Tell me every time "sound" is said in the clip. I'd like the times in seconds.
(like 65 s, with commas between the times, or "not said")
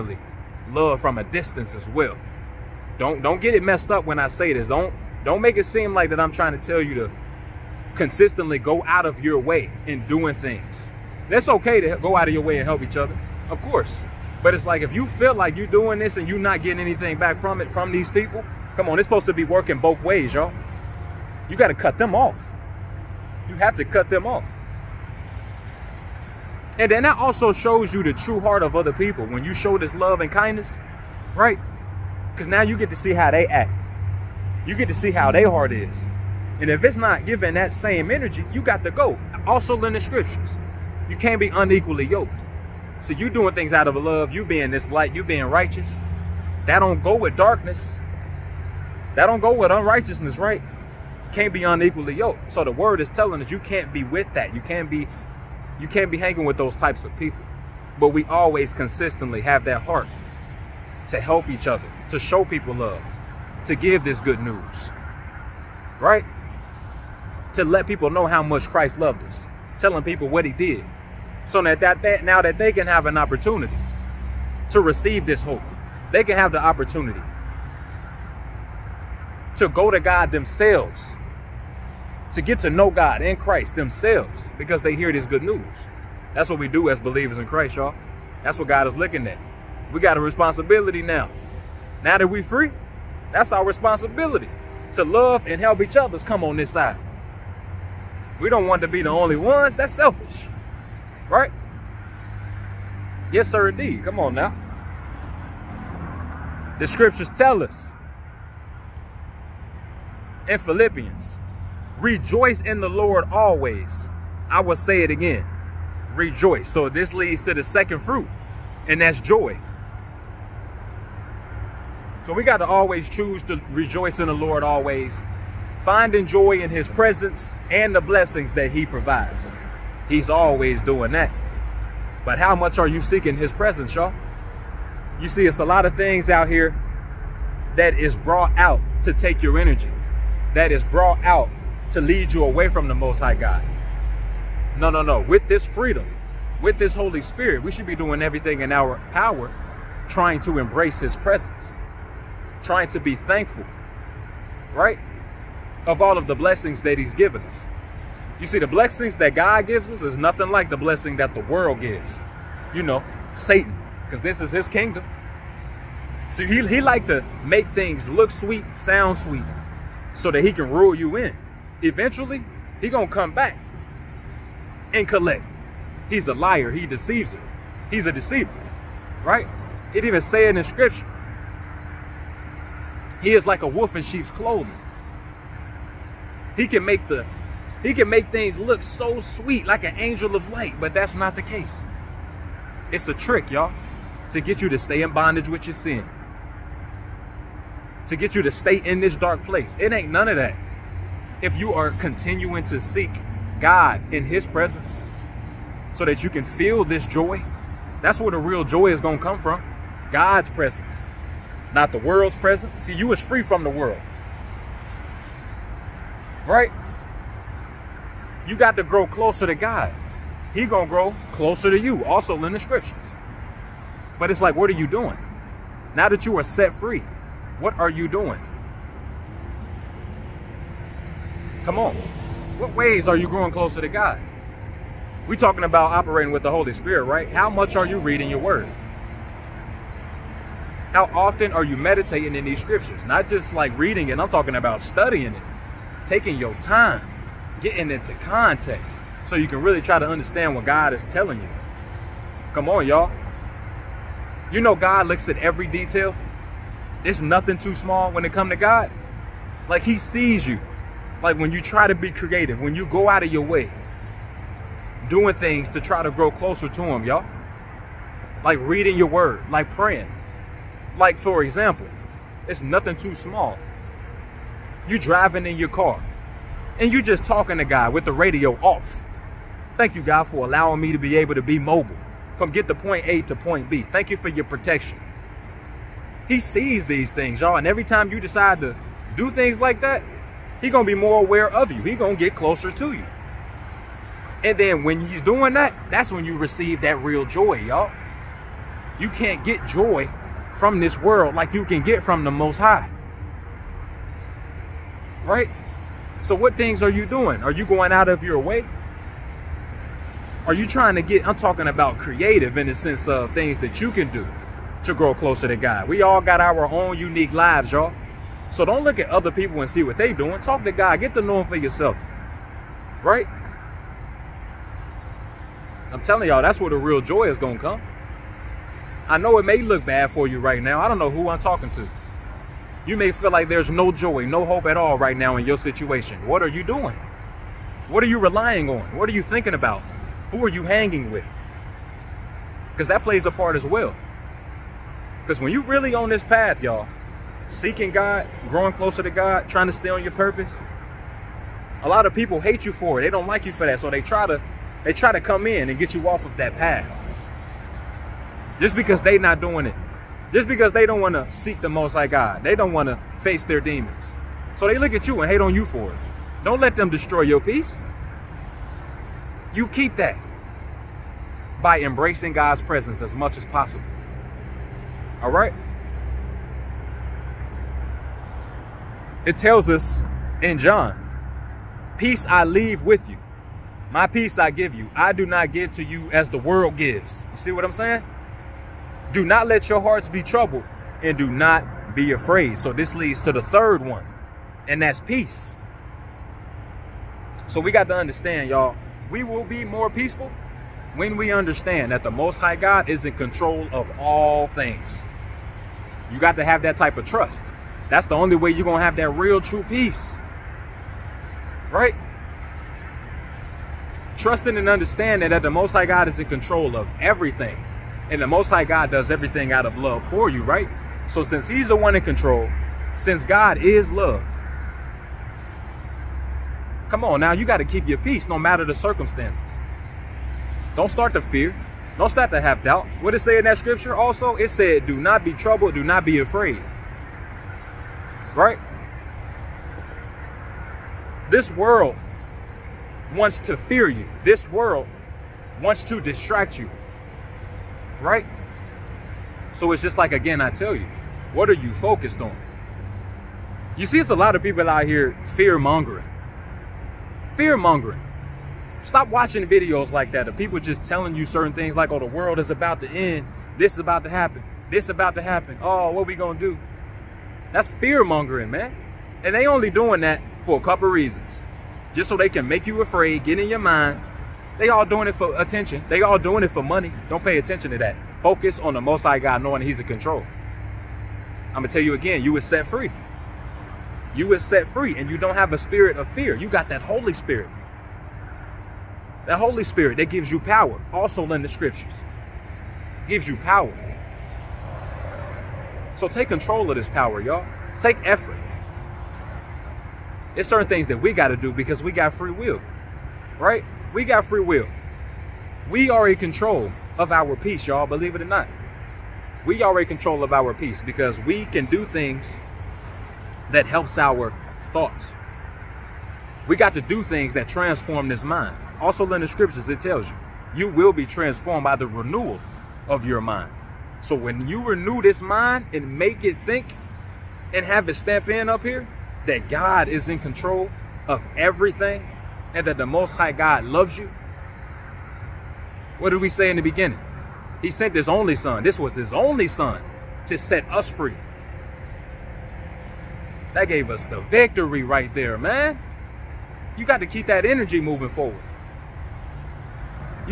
168 s.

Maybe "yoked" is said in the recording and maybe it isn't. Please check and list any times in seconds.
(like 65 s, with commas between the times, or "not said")
42 s, 52 s.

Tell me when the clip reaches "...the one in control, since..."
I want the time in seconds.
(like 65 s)
421 s.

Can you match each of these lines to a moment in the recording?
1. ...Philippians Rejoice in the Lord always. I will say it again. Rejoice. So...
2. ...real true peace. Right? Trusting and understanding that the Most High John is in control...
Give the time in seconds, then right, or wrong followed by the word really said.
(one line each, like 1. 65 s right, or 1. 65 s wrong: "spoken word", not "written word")
1. 110 s right
2. 409 s wrong: "God", not "John".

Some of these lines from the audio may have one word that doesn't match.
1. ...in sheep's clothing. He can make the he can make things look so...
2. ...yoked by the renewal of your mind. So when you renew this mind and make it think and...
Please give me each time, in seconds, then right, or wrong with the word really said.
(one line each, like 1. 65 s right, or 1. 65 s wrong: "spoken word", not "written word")
1. 183 s right
2. 521 s wrong: "transformed", not "yoked".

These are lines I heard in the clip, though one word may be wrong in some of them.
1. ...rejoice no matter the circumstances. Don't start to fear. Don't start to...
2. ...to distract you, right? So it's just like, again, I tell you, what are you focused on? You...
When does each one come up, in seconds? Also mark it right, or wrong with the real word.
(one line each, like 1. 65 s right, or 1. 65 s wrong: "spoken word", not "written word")
1. 427 s wrong: "peace", not "rejoice"
2. 445 s right.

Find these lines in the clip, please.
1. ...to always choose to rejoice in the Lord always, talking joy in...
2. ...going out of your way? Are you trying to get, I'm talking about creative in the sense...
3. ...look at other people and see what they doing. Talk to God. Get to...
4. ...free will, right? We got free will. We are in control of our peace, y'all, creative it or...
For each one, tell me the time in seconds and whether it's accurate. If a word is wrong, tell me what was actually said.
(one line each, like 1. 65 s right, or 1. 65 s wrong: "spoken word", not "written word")
1. 122 s wrong: "finding", not "talking"
2. 307 s right
3. 318 s right
4. 502 s wrong: "believe", not "creative".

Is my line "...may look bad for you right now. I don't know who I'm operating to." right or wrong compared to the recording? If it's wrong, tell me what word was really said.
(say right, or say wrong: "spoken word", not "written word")
wrong: "talking", not "operating".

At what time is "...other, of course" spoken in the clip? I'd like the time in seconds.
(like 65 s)
12 s.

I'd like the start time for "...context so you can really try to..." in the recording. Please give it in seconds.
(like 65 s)
248 s.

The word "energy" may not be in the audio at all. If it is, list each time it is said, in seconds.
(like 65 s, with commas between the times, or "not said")
38 s, 139 s, 547 s.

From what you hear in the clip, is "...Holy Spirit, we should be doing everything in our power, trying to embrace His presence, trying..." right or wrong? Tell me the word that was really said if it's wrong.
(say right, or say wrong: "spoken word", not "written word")
right.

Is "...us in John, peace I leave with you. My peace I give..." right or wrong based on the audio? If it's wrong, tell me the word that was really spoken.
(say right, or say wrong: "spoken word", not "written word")
right.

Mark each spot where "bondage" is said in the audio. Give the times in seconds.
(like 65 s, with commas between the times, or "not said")
195 s.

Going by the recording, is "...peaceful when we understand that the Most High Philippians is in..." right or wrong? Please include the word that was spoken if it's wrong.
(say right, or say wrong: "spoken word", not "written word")
wrong: "God", not "Philippians".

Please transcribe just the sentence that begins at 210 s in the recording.
God's presence, not the world's presence.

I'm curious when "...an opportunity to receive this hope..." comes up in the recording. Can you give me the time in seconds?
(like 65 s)
73 s.